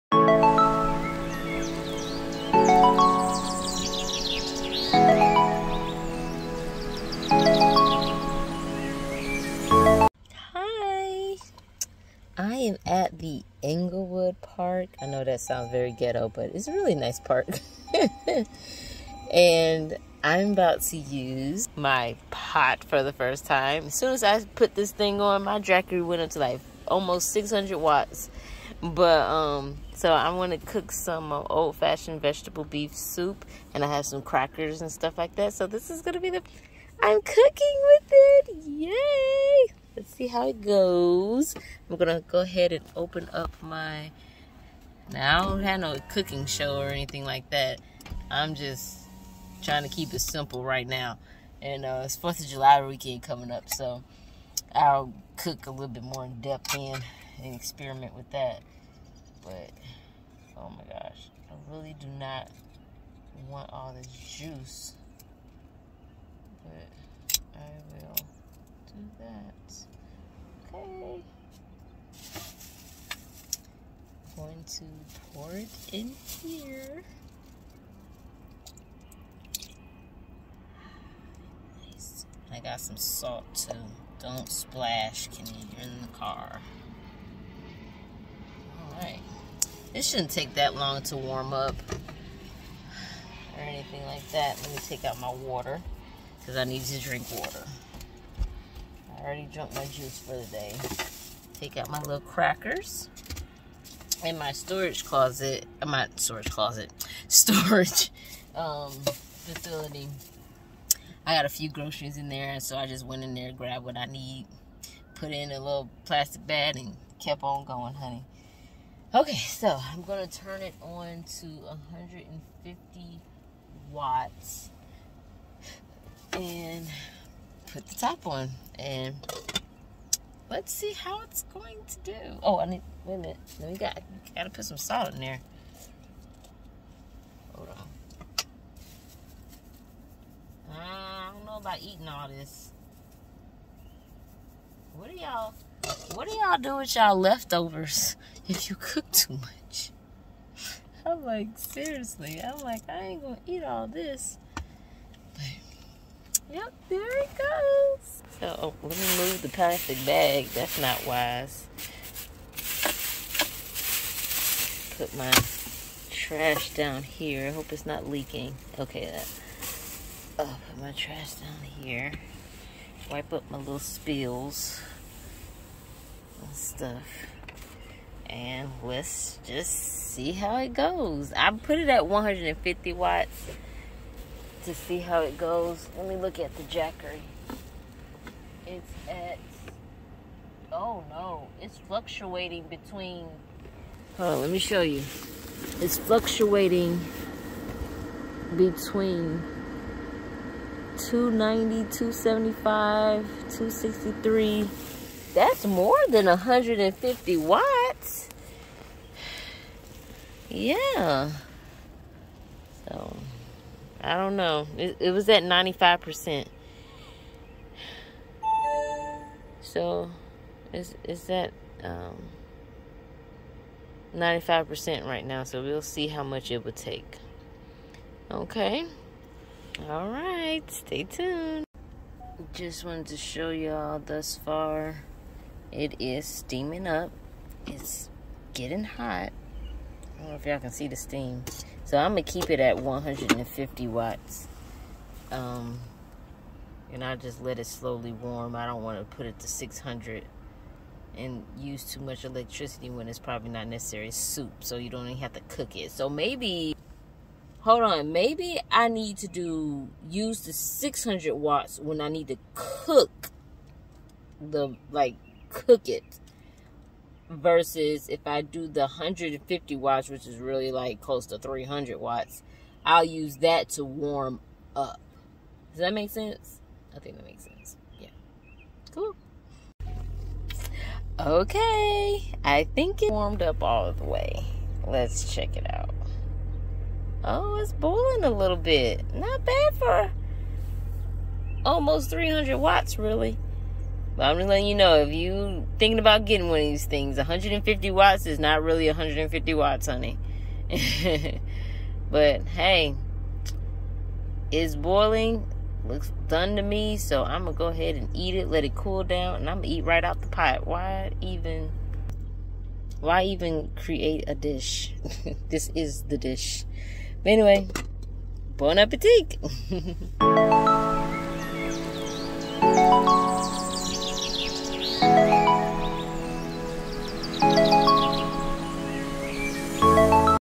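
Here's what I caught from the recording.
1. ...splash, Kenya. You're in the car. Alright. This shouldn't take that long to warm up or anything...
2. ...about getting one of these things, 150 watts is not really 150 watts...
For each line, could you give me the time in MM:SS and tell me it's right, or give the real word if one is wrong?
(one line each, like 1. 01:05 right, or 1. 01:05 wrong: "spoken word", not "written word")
1. 01:24 right
2. 04:55 right.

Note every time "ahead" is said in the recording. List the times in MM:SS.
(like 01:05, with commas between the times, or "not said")
00:42, 05:07.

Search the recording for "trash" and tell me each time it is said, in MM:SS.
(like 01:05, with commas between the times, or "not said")
02:46, 02:50.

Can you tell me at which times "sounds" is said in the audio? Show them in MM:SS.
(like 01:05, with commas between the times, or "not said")
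00:15.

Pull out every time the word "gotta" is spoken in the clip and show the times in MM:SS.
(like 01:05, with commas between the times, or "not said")
02:14.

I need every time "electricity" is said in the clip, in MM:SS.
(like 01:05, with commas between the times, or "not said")
04:12.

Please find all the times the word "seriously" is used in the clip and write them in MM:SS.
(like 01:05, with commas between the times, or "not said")
02:31.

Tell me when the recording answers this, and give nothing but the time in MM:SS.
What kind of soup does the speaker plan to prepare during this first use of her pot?
00:32.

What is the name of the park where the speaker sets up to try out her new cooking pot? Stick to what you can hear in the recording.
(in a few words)
Englewood Park.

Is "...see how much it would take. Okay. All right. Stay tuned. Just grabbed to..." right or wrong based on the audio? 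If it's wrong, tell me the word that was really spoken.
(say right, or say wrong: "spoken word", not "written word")
wrong: "wanted", not "grabbed".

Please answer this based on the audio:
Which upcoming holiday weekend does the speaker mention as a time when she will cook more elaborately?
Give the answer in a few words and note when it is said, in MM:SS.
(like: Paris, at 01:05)
Fourth of July, at 00:52.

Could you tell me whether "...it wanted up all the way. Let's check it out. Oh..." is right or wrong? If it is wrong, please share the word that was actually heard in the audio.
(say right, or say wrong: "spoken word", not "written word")
wrong: "warmed", not "wanted".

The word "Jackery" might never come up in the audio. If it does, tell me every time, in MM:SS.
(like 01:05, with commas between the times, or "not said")
00:25, 03:06.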